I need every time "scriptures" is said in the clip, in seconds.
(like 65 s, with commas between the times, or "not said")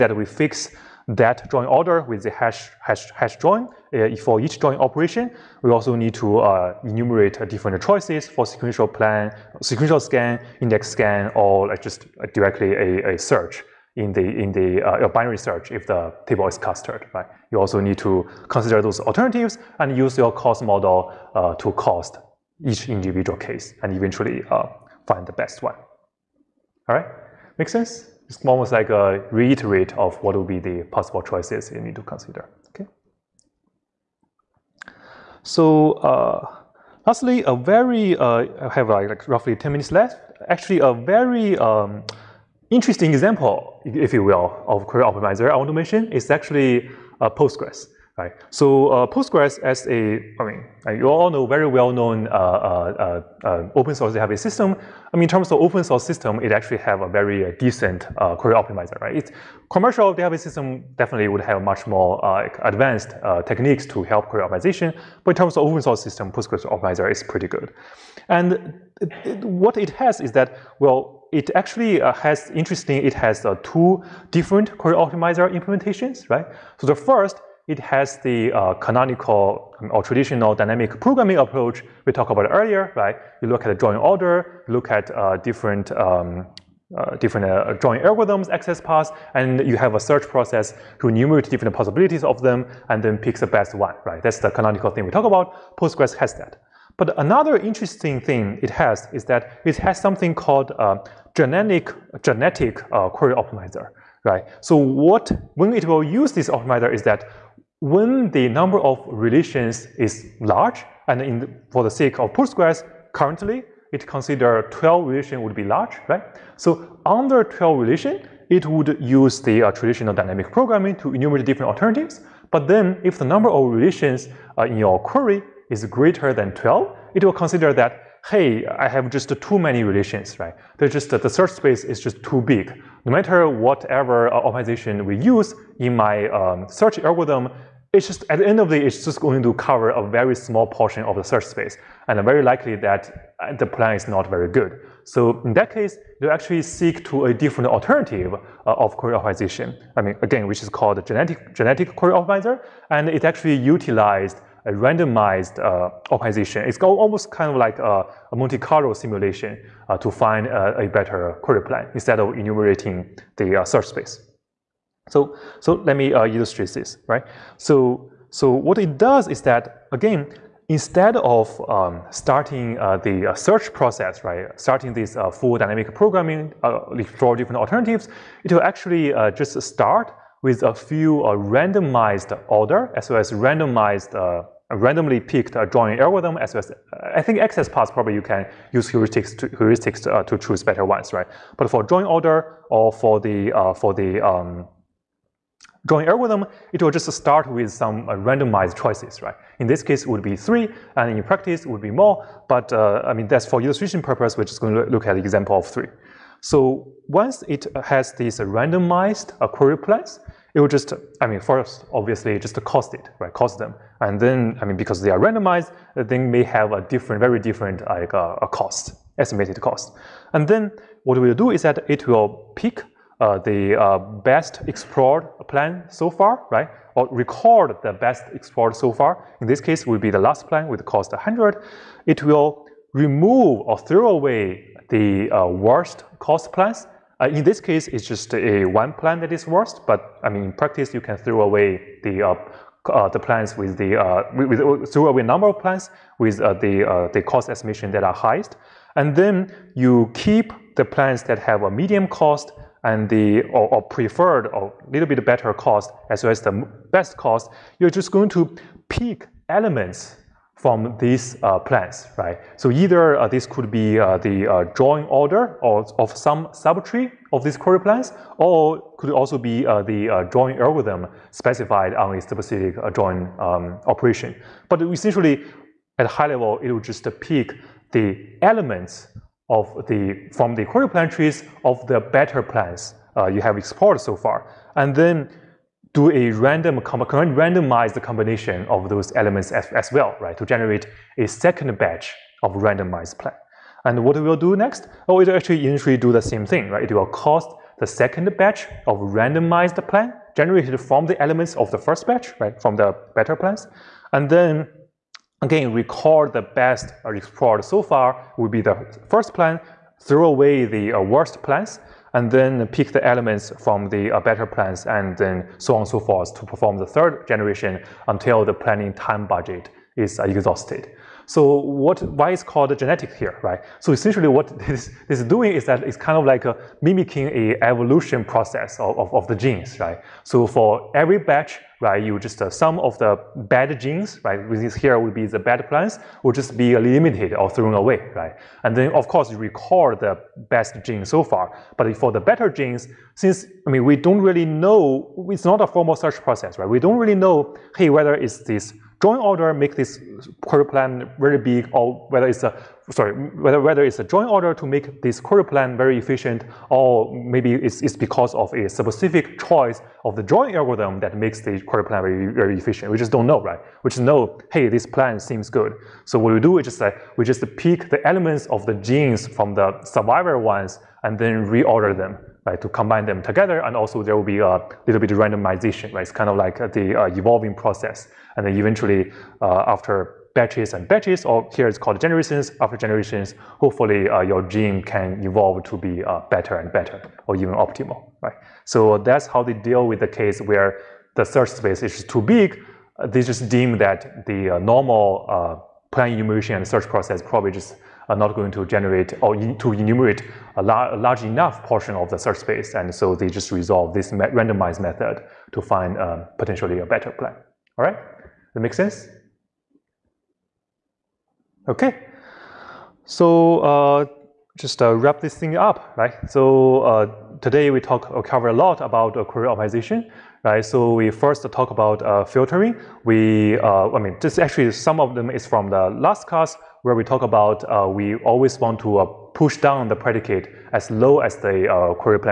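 not said.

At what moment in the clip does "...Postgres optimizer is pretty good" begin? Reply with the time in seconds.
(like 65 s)
66 s.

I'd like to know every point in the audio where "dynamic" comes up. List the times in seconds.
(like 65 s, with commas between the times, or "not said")
80 s, 120 s, 175 s.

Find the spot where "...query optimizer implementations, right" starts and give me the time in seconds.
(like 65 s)
74 s.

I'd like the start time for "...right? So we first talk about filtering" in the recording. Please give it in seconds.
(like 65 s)
420 s.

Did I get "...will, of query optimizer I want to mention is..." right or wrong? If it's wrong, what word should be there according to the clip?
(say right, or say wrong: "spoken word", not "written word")
right.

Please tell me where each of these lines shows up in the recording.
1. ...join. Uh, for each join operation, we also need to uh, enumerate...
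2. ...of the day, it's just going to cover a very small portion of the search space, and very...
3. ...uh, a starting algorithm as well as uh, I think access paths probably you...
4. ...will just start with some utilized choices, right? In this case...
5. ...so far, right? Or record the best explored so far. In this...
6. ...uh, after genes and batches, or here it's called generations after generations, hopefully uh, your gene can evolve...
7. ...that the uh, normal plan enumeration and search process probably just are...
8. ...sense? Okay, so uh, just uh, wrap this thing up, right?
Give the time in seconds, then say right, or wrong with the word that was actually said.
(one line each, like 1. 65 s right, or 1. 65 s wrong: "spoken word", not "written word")
1. 3 s right
2. 138 s right
3. 185 s wrong: "joining", not "starting"
4. 196 s wrong: "randomized", not "utilized"
5. 225 s right
6. 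379 s wrong: "batches", not "genes"
7. 393 s right
8. 408 s right.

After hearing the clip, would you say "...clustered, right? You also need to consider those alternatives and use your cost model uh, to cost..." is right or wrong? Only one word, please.
right.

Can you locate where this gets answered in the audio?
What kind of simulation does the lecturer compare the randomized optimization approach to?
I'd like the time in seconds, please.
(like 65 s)
158 s.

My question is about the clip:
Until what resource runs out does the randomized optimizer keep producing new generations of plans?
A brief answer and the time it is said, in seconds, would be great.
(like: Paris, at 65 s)
planning time budget, at 318 s.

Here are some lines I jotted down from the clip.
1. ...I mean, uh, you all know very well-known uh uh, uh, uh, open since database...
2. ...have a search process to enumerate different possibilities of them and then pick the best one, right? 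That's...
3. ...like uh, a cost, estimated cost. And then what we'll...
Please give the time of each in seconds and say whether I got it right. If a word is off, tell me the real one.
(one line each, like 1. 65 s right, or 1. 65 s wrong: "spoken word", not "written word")
1. 50 s wrong: "source", not "since"
2. 89 s right
3. 217 s right.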